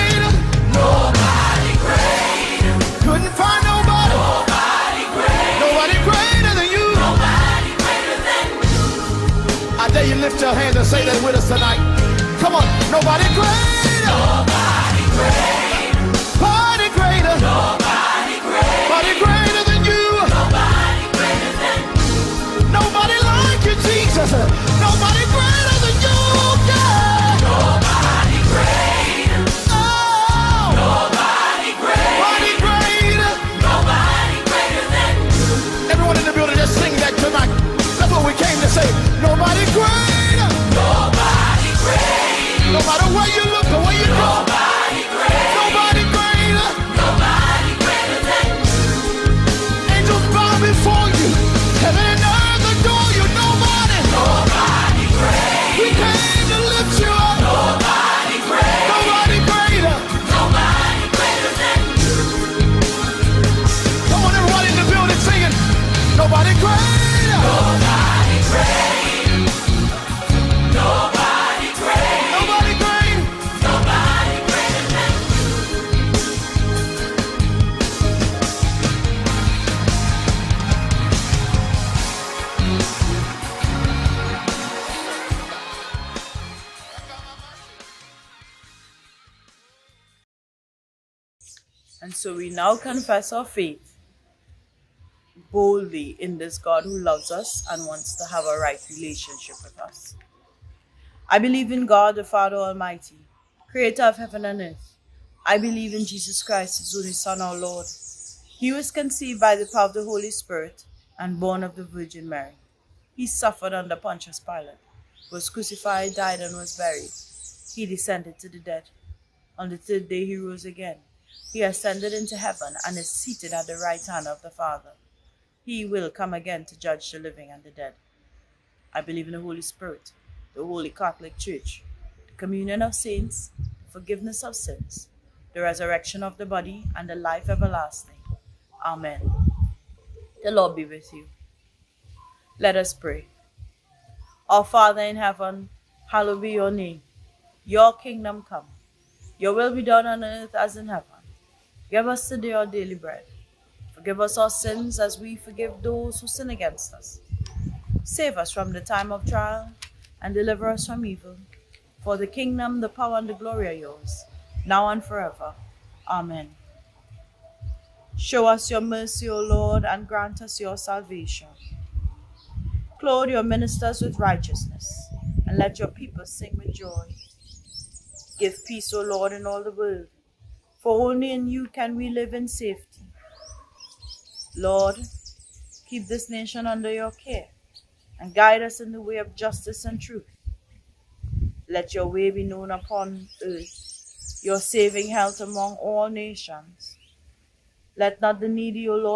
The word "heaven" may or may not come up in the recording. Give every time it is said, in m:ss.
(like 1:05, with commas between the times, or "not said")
1:44, 2:02, 2:25, 2:30.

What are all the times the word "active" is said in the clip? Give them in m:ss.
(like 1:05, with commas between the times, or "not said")
not said.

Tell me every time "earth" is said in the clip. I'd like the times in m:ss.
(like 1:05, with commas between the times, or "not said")
1:44, 2:30, 3:13.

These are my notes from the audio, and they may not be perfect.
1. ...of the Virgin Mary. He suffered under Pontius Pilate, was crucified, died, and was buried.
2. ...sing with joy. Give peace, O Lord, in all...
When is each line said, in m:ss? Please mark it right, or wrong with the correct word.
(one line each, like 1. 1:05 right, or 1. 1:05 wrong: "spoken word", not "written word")
1. 1:51 right
2. 2:56 right.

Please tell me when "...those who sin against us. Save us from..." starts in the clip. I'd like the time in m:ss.
2:35.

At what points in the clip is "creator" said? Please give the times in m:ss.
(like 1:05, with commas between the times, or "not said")
1:43.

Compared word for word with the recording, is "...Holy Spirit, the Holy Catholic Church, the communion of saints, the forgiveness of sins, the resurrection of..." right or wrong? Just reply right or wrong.
right.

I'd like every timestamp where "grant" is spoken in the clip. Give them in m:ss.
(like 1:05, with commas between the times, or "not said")
2:50.